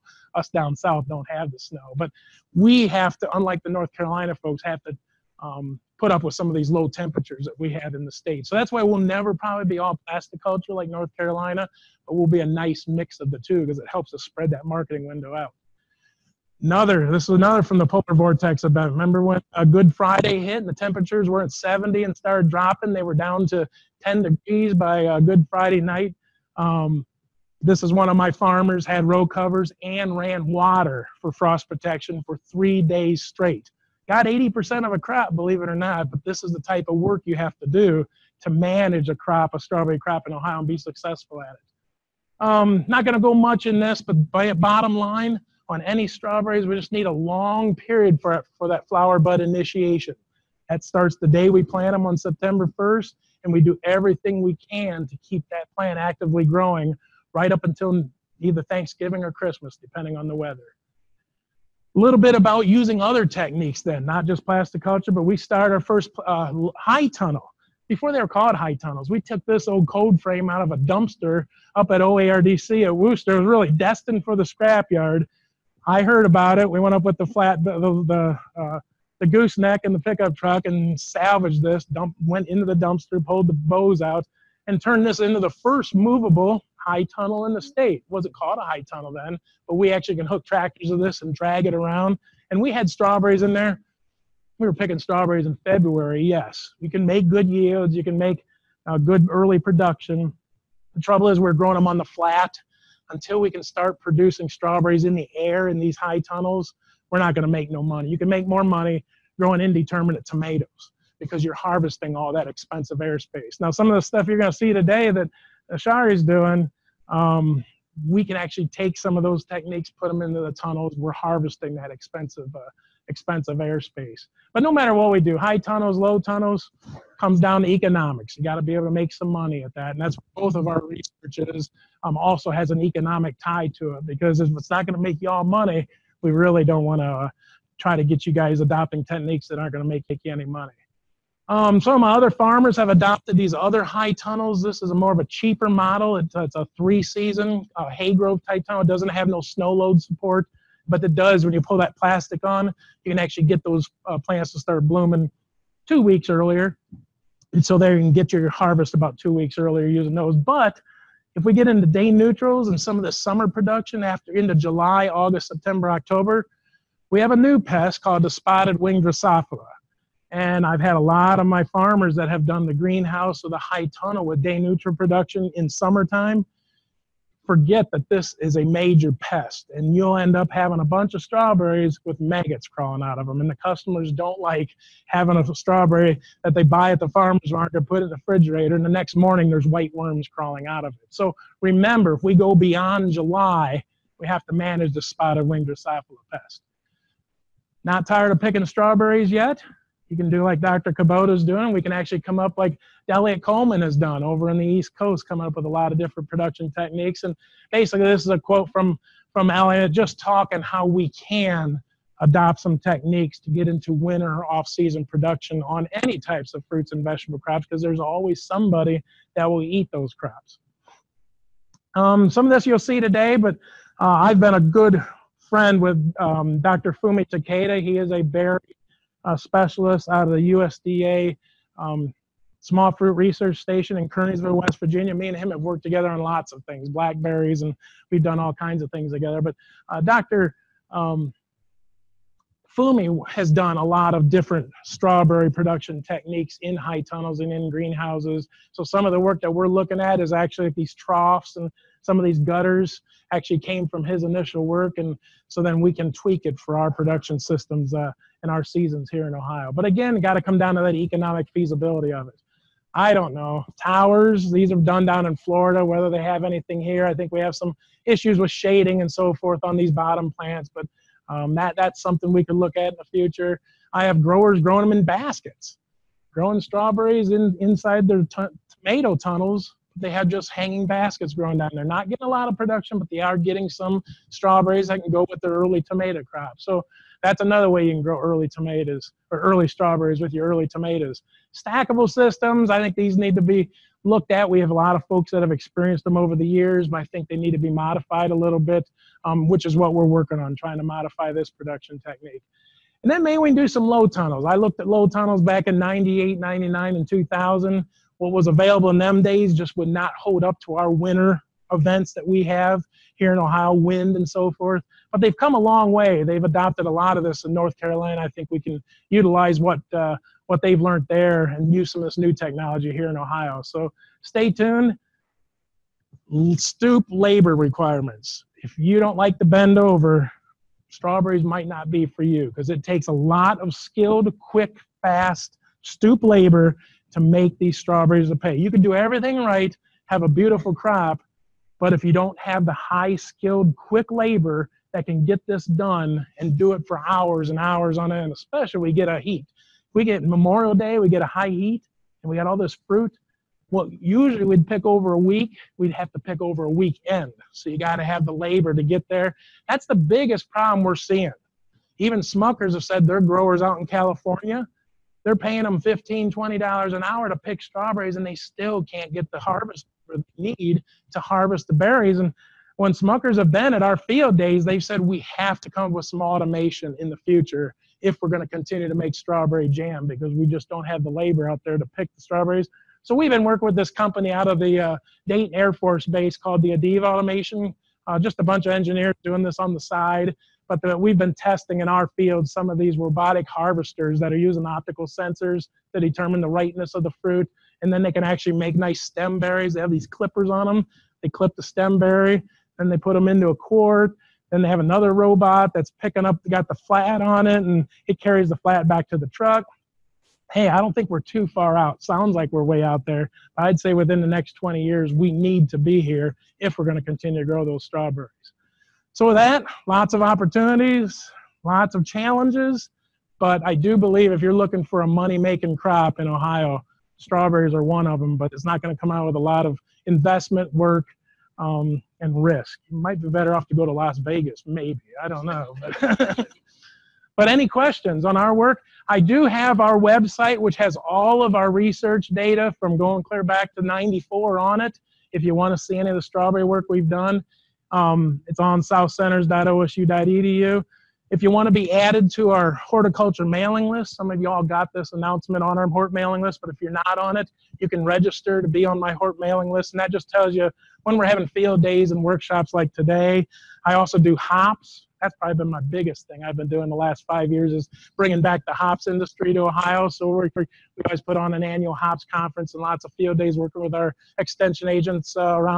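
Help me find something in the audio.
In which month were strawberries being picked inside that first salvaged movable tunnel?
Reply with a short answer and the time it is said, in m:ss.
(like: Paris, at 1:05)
February, at 1:35.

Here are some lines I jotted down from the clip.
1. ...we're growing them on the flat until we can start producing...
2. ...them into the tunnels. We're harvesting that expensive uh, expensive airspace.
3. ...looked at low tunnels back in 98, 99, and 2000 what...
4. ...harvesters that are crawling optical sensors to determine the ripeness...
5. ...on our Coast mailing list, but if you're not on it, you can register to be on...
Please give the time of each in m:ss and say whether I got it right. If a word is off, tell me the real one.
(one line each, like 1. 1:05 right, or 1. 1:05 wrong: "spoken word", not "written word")
1. 1:41 right
2. 2:00 right
3. 5:04 right
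4. 6:33 wrong: "using", not "crawling"
5. 7:35 wrong: "Hort", not "Coast".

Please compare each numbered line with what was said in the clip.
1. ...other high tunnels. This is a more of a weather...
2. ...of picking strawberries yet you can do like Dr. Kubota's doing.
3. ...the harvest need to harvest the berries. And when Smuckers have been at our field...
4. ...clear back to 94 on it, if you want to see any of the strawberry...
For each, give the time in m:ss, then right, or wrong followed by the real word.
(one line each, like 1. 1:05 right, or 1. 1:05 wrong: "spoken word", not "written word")
1. 2:23 wrong: "cheaper", not "weather"
2. 3:18 right
3. 6:09 right
4. 7:23 right.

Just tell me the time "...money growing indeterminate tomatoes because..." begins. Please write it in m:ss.
1:48.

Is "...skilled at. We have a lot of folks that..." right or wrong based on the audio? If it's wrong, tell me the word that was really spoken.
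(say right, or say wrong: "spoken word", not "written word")
wrong: "looked", not "skilled".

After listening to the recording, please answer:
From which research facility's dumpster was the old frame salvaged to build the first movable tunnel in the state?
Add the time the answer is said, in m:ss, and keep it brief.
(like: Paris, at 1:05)
OARDC at Wooster, at 1:12.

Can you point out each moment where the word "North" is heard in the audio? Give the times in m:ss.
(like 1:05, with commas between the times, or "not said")
0:03, 0:10, 5:17.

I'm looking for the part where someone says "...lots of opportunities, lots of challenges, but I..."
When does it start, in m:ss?
6:59.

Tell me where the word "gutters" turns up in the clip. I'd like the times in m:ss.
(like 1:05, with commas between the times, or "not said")
4:12.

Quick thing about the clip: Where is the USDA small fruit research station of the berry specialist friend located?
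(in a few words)
Kearneysville, West Virginia.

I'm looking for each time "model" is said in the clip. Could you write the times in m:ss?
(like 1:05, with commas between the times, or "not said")
2:25.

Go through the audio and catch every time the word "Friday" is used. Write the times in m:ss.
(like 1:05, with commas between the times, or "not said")
0:19, 0:25.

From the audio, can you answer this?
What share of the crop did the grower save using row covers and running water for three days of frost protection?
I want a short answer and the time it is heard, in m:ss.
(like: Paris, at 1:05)
80%, at 0:34.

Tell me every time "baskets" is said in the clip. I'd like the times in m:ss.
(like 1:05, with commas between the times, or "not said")
4:35, 4:40.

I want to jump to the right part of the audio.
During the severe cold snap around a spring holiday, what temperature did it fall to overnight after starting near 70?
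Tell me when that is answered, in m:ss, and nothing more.
0:24.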